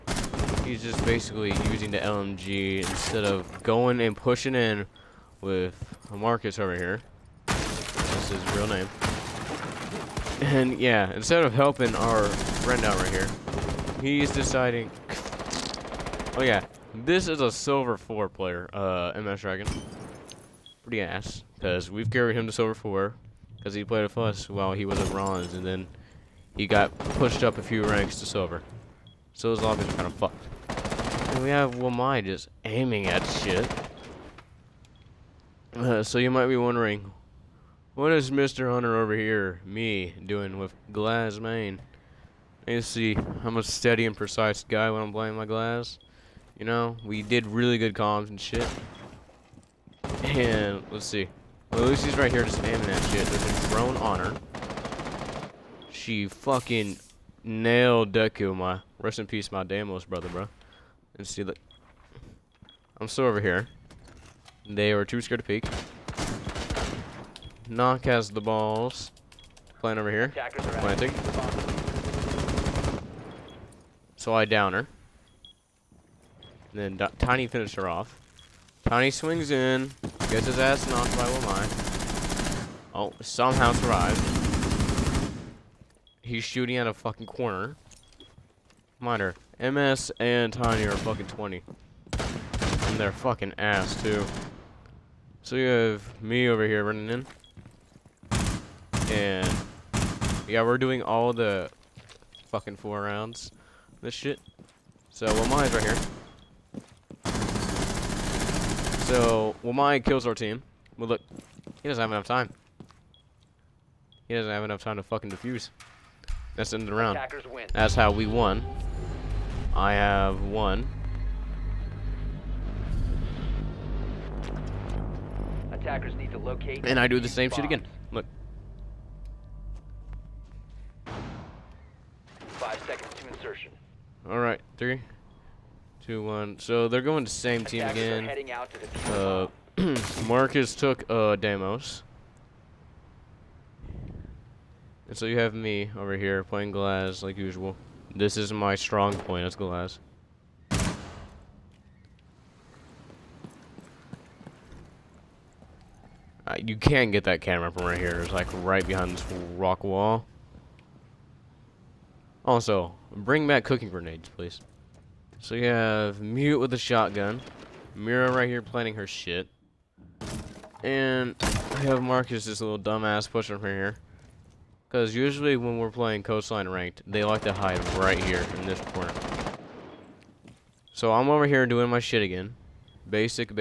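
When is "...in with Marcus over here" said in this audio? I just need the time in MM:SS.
00:04.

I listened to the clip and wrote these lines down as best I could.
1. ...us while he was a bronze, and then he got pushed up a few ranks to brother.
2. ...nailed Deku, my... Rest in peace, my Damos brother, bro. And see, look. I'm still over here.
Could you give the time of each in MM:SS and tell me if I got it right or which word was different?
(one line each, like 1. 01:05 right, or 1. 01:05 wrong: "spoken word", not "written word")
1. 00:24 wrong: "silver", not "brother"
2. 00:57 right.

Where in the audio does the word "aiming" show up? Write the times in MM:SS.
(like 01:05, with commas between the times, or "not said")
00:32, 00:52.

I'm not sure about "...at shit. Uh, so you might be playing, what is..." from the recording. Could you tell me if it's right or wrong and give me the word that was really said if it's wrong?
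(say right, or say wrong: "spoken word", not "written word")
wrong: "wondering", not "playing".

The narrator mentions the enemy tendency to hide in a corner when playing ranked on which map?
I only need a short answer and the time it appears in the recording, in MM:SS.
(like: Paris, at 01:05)
Coastline, at 02:56.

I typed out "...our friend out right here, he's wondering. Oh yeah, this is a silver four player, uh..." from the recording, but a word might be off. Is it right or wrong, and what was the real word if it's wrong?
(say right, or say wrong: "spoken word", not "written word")
wrong: "deciding", not "wondering".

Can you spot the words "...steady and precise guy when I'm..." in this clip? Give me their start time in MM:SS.
00:43.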